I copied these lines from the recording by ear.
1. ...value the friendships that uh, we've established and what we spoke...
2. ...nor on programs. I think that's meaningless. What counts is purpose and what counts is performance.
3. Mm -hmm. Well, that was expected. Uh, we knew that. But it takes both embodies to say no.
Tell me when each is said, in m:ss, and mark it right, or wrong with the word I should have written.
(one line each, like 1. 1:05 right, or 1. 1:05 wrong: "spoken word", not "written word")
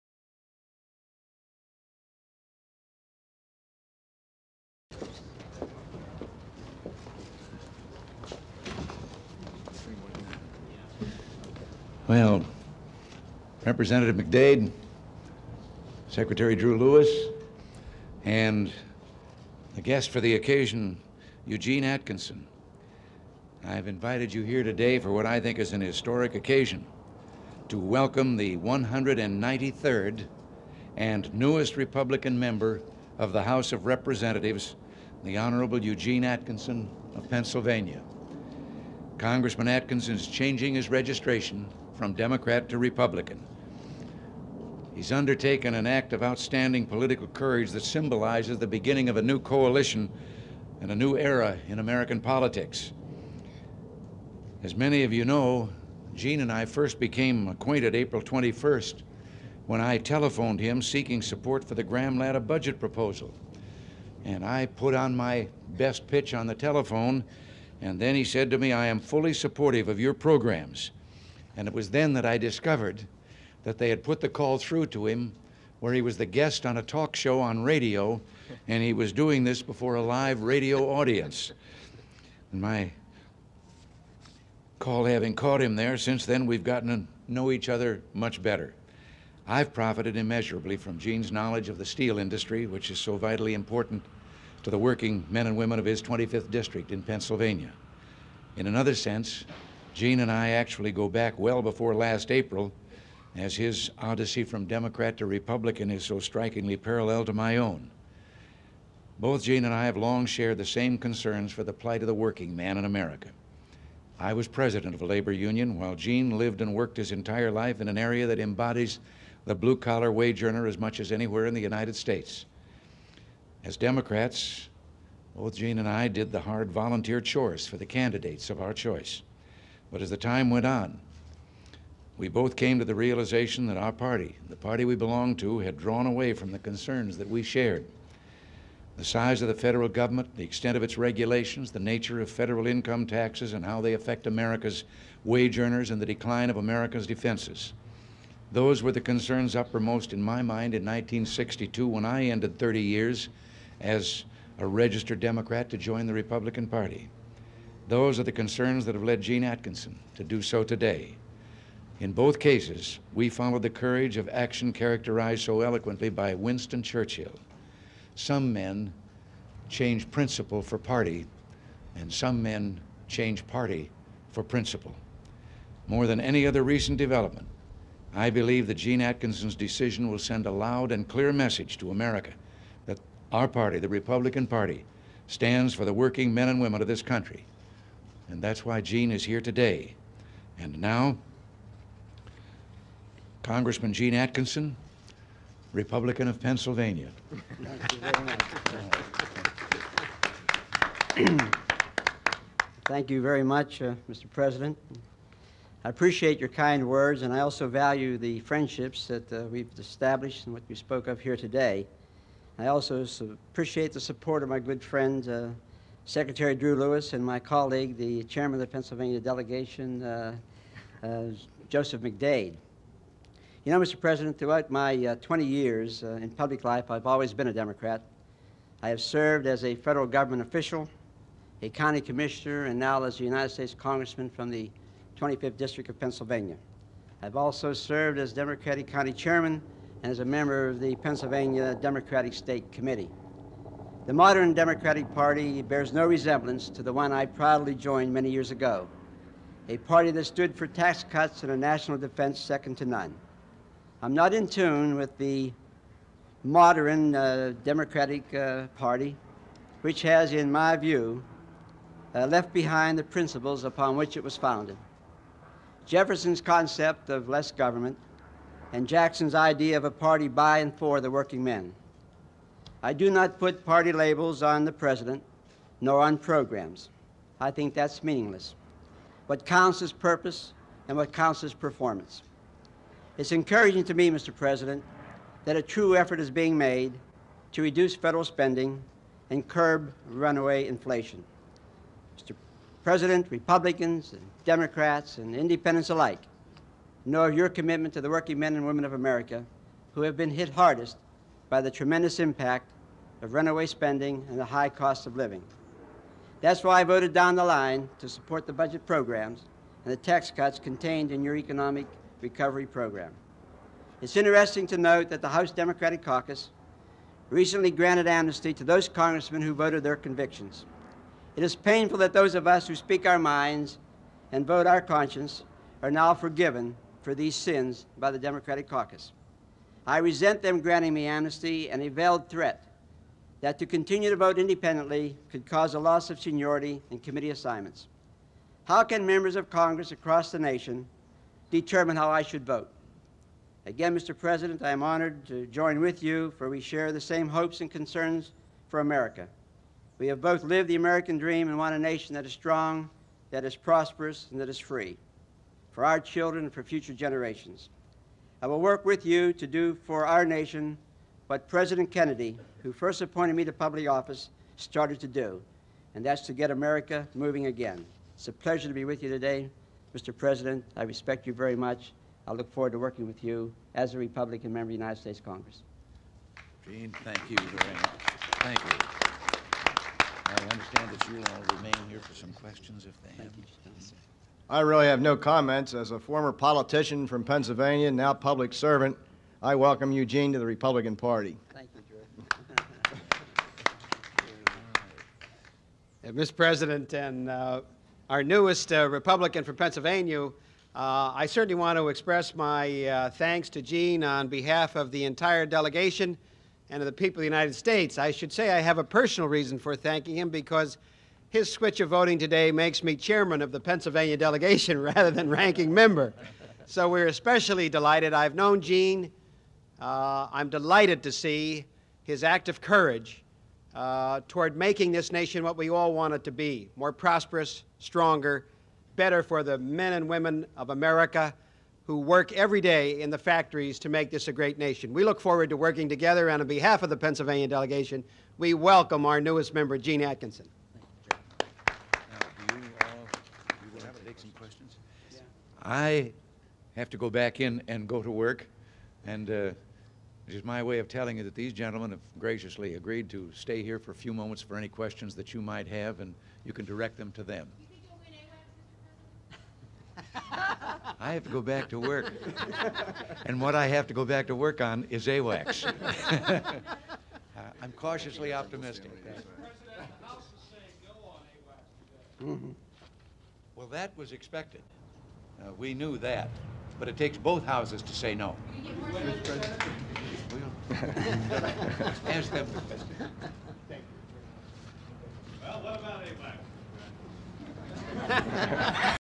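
1. 3:27 right
2. 4:35 right
3. 7:52 wrong: "houses", not "embodies".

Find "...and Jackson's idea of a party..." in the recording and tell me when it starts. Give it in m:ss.
4:28.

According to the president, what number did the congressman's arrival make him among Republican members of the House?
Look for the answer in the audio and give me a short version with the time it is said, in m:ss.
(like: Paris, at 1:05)
193rd, at 0:28.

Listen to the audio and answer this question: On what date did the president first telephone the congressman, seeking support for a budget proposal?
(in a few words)
April 21st.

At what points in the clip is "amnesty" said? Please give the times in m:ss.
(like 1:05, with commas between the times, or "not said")
5:18, 5:31.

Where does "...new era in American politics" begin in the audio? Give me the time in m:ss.
0:50.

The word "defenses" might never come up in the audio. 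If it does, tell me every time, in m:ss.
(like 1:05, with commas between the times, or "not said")
2:27, 4:11.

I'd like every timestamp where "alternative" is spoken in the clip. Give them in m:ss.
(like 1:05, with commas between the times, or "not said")
not said.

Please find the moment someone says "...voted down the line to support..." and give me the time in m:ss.
5:06.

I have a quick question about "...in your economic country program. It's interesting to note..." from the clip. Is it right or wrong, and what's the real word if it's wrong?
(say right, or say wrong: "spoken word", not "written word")
wrong: "recovery", not "country".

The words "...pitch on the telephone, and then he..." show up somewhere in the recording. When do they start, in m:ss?
1:06.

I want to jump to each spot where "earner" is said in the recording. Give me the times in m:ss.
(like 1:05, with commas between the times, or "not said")
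2:00, 2:25.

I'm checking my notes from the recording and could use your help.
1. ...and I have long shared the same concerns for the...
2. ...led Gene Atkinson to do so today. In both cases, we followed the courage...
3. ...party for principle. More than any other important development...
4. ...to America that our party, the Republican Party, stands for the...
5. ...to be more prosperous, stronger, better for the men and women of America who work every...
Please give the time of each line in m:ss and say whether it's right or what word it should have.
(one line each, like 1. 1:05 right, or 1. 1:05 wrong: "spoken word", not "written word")
1. 1:49 right
2. 2:39 right
3. 2:53 wrong: "recent", not "important"
4. 3:01 right
5. 7:06 right.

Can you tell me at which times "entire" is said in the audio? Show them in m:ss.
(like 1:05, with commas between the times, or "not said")
1:57, 6:45.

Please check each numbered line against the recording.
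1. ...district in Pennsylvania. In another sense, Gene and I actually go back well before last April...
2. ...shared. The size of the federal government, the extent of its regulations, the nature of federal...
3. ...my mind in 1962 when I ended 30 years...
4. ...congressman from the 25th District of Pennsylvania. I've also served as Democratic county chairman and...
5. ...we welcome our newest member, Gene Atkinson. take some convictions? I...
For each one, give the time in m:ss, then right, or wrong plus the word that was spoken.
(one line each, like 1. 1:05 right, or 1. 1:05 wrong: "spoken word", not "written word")
1. 1:36 right
2. 2:17 right
3. 2:30 right
4. 3:53 right
5. 7:18 wrong: "questions", not "convictions".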